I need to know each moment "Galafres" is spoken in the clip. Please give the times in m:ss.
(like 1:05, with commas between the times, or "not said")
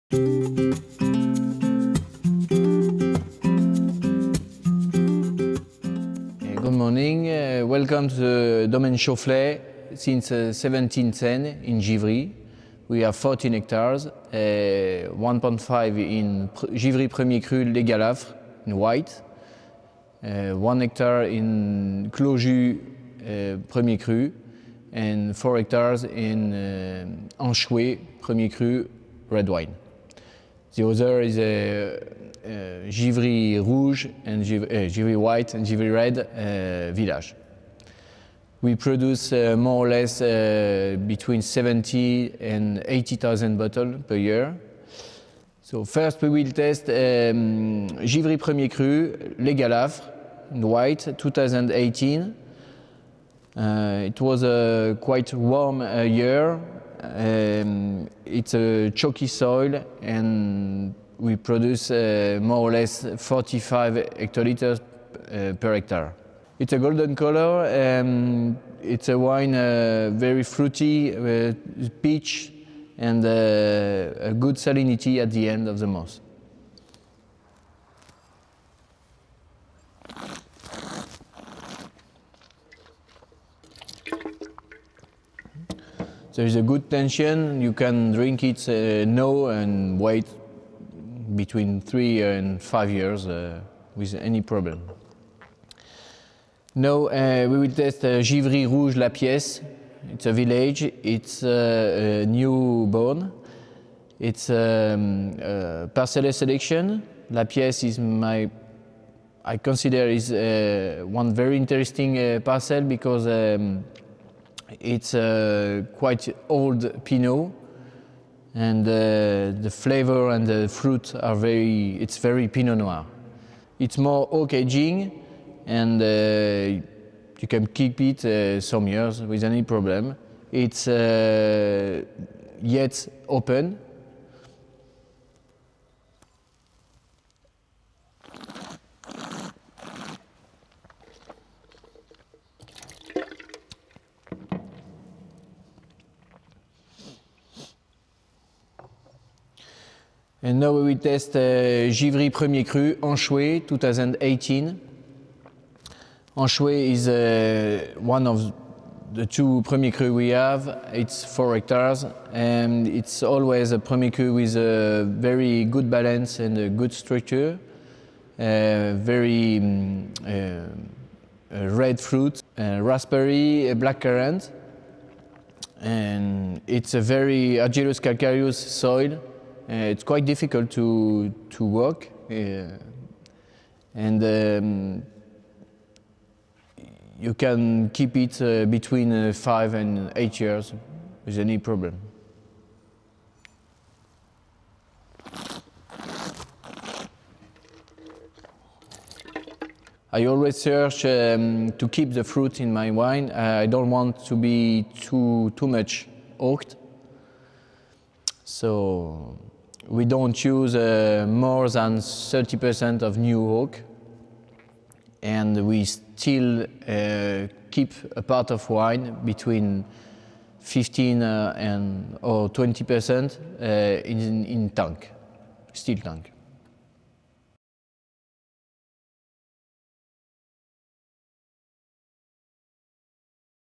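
0:17, 0:49.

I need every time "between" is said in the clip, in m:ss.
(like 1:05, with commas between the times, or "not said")
0:41, 1:31, 3:08, 3:39.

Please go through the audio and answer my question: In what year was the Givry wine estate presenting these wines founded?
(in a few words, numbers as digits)
1710.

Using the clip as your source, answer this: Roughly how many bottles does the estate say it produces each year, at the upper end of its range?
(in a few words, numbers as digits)
80,000.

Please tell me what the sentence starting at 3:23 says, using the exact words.
I don't want to be too too much oaked.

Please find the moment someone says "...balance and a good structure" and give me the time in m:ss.
2:45.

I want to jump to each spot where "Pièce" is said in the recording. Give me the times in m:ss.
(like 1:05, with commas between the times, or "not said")
1:39, 1:47.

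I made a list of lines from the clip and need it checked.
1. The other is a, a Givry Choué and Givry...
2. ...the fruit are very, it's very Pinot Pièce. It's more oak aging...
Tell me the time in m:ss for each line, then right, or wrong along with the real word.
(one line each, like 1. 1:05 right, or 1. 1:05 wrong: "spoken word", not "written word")
1. 0:30 wrong: "Rouge", not "Choué"
2. 2:00 wrong: "Noir", not "Pièce".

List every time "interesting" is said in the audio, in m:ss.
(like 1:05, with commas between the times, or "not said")
1:51.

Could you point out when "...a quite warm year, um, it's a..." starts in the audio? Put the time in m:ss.
0:54.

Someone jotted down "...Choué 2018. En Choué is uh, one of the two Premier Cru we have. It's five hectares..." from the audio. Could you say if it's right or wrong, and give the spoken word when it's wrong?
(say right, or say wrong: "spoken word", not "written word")
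wrong: "four", not "five".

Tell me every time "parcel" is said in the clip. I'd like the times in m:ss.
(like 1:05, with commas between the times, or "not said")
1:45, 1:52.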